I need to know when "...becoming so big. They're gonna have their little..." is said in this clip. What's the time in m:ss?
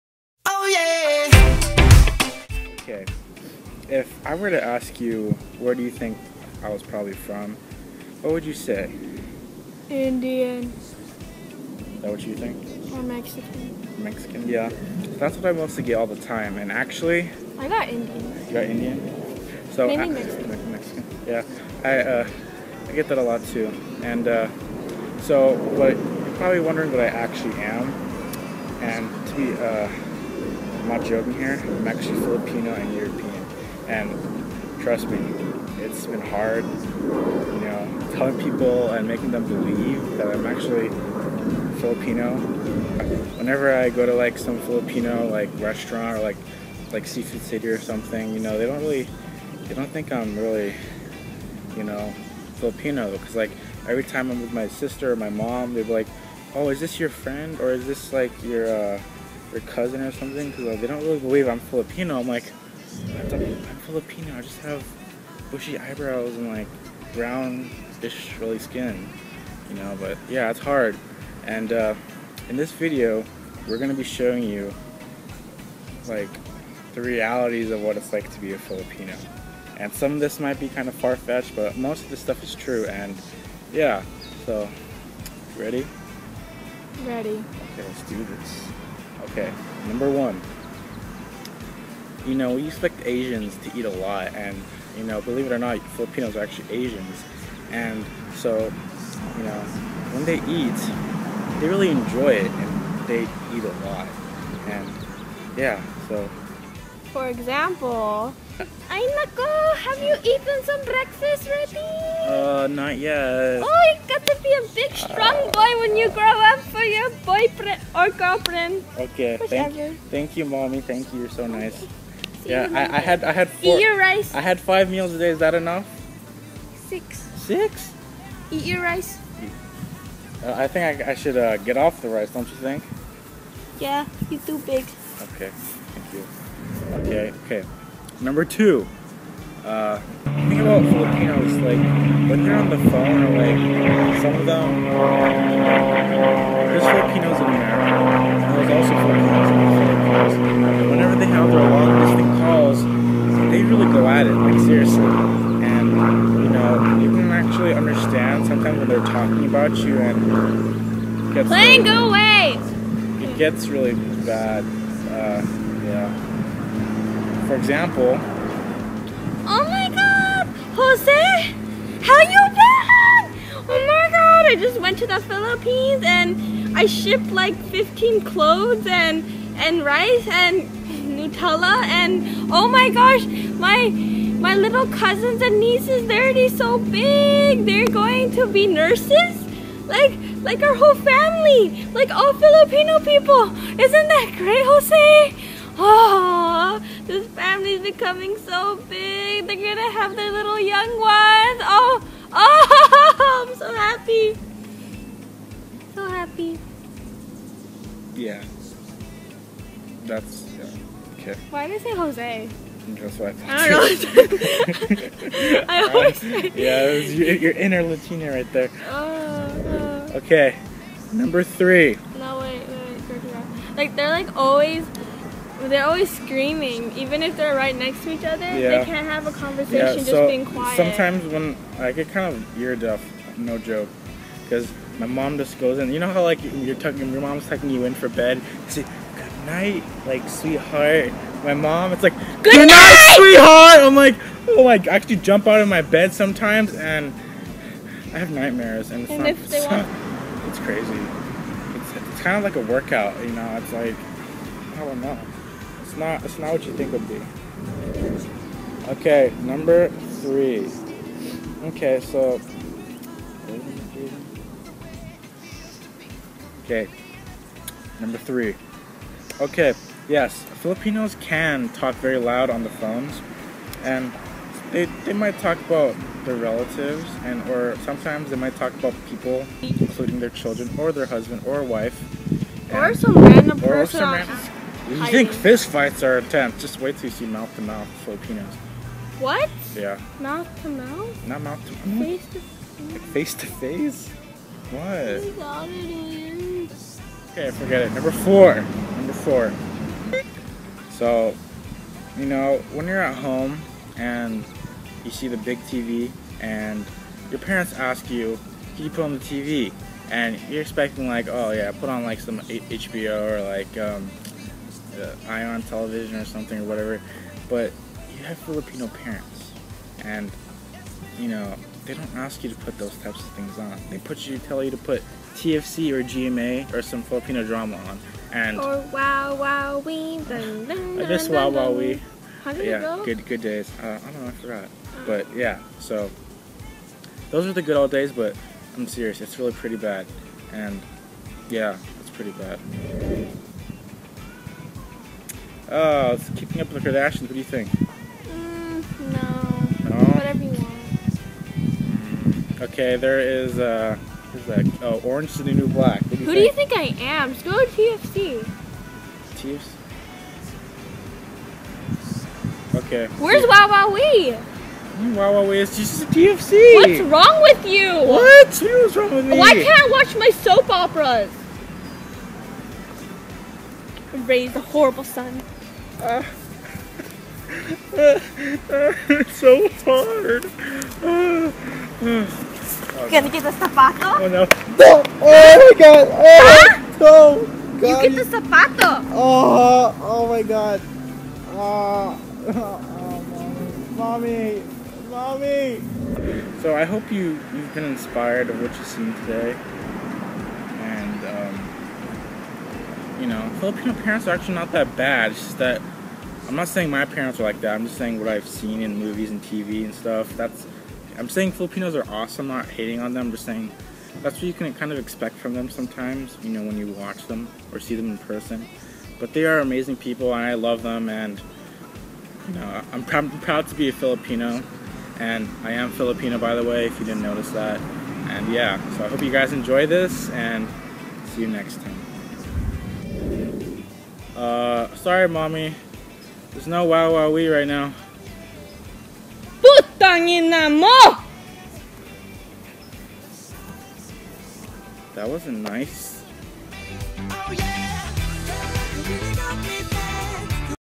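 3:17.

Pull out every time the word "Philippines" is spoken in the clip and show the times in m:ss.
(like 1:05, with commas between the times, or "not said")
2:30, 2:55.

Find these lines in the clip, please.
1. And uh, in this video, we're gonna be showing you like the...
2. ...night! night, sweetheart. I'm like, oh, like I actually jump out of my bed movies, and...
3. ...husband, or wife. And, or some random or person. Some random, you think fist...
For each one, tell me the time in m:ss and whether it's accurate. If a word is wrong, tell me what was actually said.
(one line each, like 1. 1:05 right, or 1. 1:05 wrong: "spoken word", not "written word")
1. 1:11 right
2. 4:02 wrong: "sometimes", not "movies"
3. 4:41 right.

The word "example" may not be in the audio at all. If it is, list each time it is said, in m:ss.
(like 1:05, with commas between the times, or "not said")
1:47, 2:47.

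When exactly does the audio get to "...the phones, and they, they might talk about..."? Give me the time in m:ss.
4:32.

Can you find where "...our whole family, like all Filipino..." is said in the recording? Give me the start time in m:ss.
3:10.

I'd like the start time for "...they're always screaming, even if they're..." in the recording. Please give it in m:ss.
3:45.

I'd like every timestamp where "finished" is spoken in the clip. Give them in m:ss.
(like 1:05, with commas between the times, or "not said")
not said.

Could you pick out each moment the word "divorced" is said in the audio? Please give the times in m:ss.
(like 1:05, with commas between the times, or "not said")
not said.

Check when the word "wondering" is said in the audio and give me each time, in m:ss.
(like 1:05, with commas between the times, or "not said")
0:26.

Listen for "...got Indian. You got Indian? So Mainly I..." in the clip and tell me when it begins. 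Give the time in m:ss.
0:17.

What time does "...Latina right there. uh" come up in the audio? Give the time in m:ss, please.
3:37.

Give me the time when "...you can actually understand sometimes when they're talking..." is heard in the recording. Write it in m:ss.
2:37.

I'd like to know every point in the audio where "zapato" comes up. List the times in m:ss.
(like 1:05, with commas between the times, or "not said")
6:23, 6:28.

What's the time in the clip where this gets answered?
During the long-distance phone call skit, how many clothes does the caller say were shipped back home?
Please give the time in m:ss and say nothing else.
2:57.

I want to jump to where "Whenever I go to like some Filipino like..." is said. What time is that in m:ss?
0:43.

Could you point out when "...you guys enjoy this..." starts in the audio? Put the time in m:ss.
7:09.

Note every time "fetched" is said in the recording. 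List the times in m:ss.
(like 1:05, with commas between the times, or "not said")
1:20.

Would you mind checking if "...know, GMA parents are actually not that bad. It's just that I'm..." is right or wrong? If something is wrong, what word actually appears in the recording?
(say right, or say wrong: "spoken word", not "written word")
wrong: "Filipino", not "GMA".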